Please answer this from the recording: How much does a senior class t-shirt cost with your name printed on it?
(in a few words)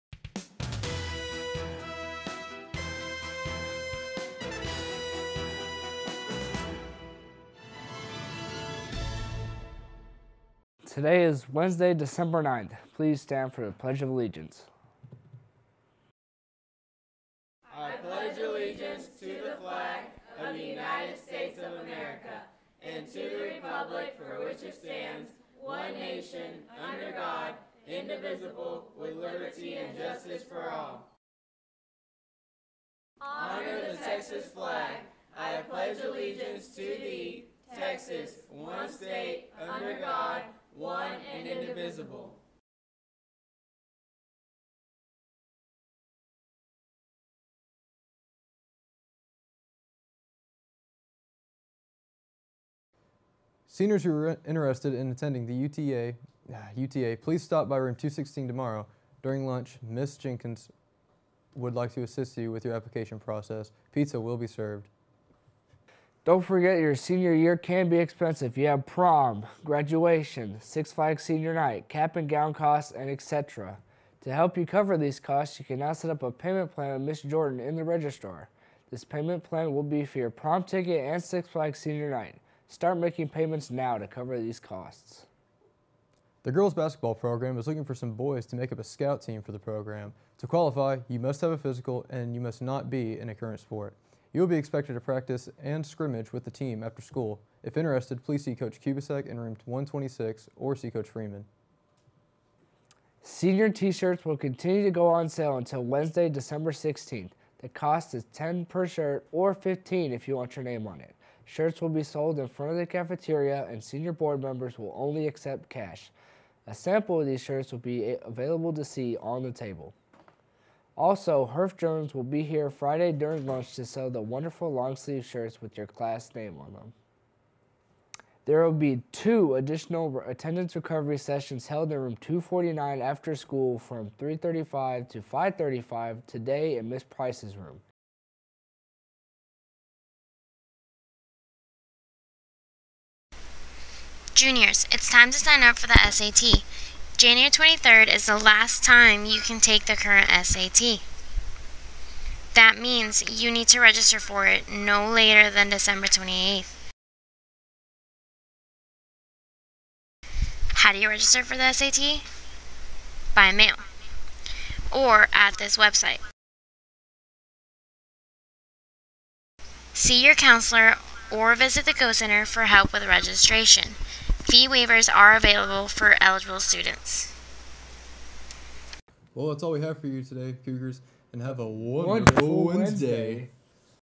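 15.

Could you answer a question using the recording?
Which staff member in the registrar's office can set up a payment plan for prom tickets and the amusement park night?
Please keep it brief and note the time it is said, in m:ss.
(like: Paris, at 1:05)
Miss Jordan, at 1:17.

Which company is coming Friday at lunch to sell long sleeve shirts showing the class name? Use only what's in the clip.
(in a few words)
Herff Jones.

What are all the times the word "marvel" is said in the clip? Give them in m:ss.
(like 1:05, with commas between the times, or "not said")
not said.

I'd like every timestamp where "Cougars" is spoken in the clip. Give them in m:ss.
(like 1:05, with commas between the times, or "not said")
3:00.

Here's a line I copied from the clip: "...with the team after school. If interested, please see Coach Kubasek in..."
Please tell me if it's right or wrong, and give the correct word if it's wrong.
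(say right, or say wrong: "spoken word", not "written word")
right.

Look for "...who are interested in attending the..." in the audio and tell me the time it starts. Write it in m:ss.
0:54.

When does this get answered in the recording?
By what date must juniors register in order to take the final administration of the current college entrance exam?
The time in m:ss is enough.
2:35.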